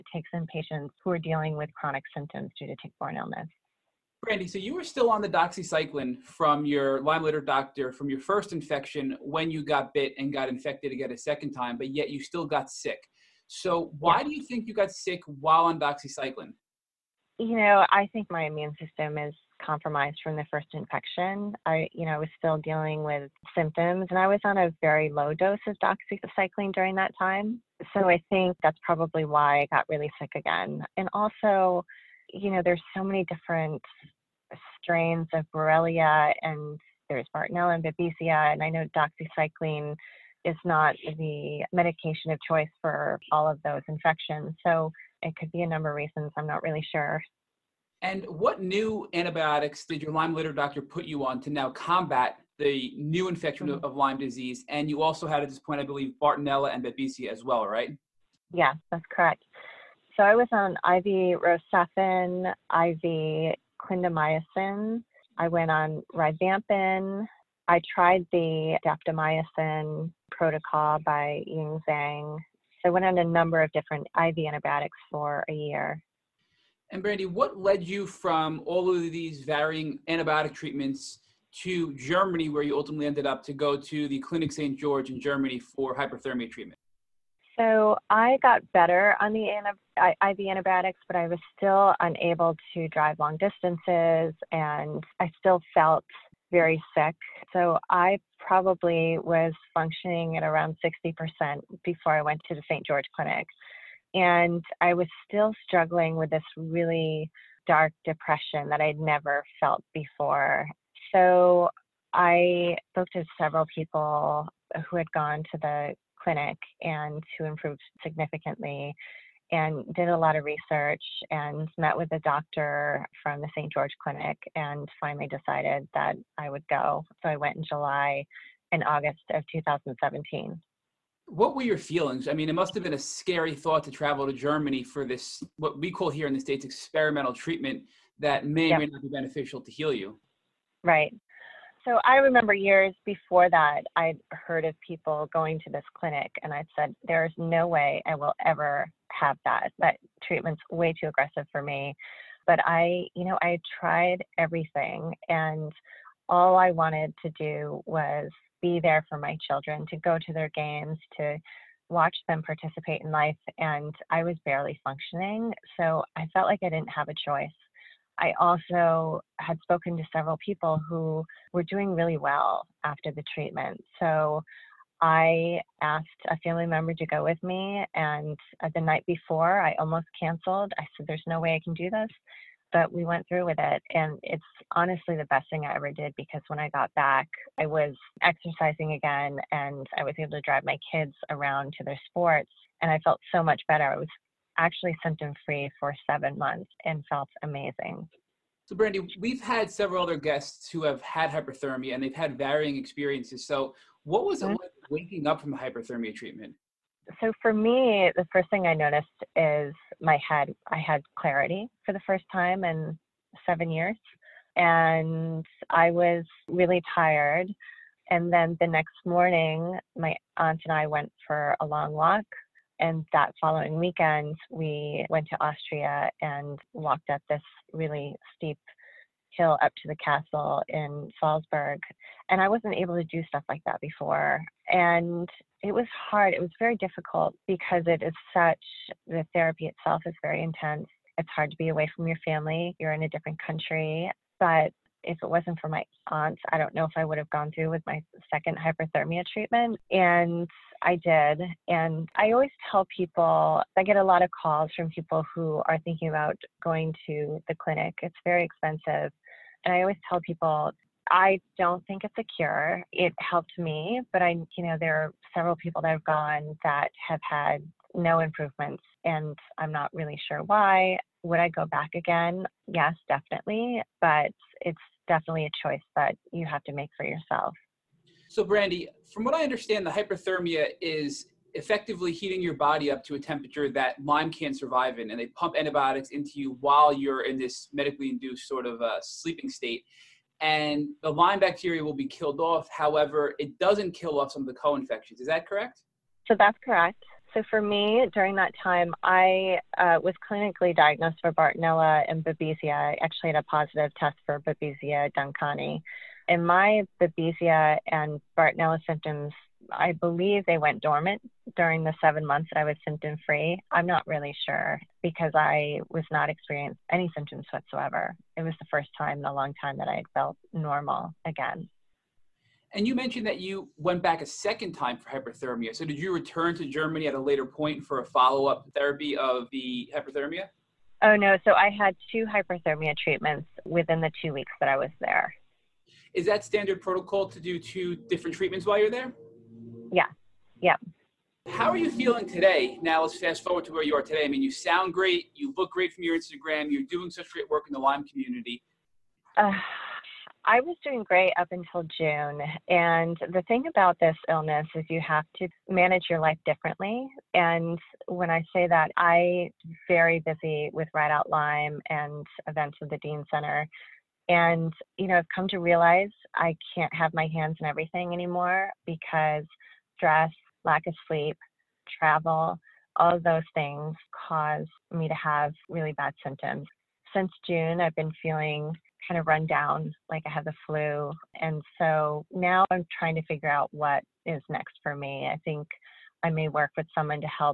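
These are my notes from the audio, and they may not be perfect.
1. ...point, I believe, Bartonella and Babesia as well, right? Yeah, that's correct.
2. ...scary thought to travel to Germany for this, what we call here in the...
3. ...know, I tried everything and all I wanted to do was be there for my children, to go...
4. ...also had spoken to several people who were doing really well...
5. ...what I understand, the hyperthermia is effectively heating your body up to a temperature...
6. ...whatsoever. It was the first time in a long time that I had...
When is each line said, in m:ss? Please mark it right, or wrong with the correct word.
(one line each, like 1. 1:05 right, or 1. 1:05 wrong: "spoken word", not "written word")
1. 0:55 right
2. 2:12 right
3. 2:33 right
4. 2:48 right
5. 4:39 right
6. 5:17 right.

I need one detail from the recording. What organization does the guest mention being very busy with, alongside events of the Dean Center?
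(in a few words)
Ride Out Lyme.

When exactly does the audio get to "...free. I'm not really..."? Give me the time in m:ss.
5:13.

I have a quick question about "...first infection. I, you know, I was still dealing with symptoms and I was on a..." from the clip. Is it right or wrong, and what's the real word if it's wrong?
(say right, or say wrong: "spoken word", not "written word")
right.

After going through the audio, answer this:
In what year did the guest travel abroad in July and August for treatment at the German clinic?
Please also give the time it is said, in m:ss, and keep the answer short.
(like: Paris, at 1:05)
2017, at 2:09.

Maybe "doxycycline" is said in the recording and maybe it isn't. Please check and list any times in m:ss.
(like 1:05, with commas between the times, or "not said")
0:05, 0:15, 0:25, 0:38.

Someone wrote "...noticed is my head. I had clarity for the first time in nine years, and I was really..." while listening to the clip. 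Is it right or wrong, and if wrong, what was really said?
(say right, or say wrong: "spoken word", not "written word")
wrong: "seven", not "nine".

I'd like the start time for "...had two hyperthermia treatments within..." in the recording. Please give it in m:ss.
5:31.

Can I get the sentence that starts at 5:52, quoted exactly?
And the thing about this illness is you have to manage your life differently.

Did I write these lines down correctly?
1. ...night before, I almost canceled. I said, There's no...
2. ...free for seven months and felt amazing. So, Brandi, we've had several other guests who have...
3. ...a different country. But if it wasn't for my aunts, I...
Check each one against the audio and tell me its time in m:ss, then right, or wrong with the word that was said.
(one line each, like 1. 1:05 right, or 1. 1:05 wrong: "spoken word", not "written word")
1. 2:58 right
2. 3:15 right
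3. 4:03 right.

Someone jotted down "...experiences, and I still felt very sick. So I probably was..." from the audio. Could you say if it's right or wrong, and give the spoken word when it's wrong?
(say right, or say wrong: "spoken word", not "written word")
wrong: "distances", not "experiences".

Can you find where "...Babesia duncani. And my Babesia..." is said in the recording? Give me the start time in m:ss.
5:04.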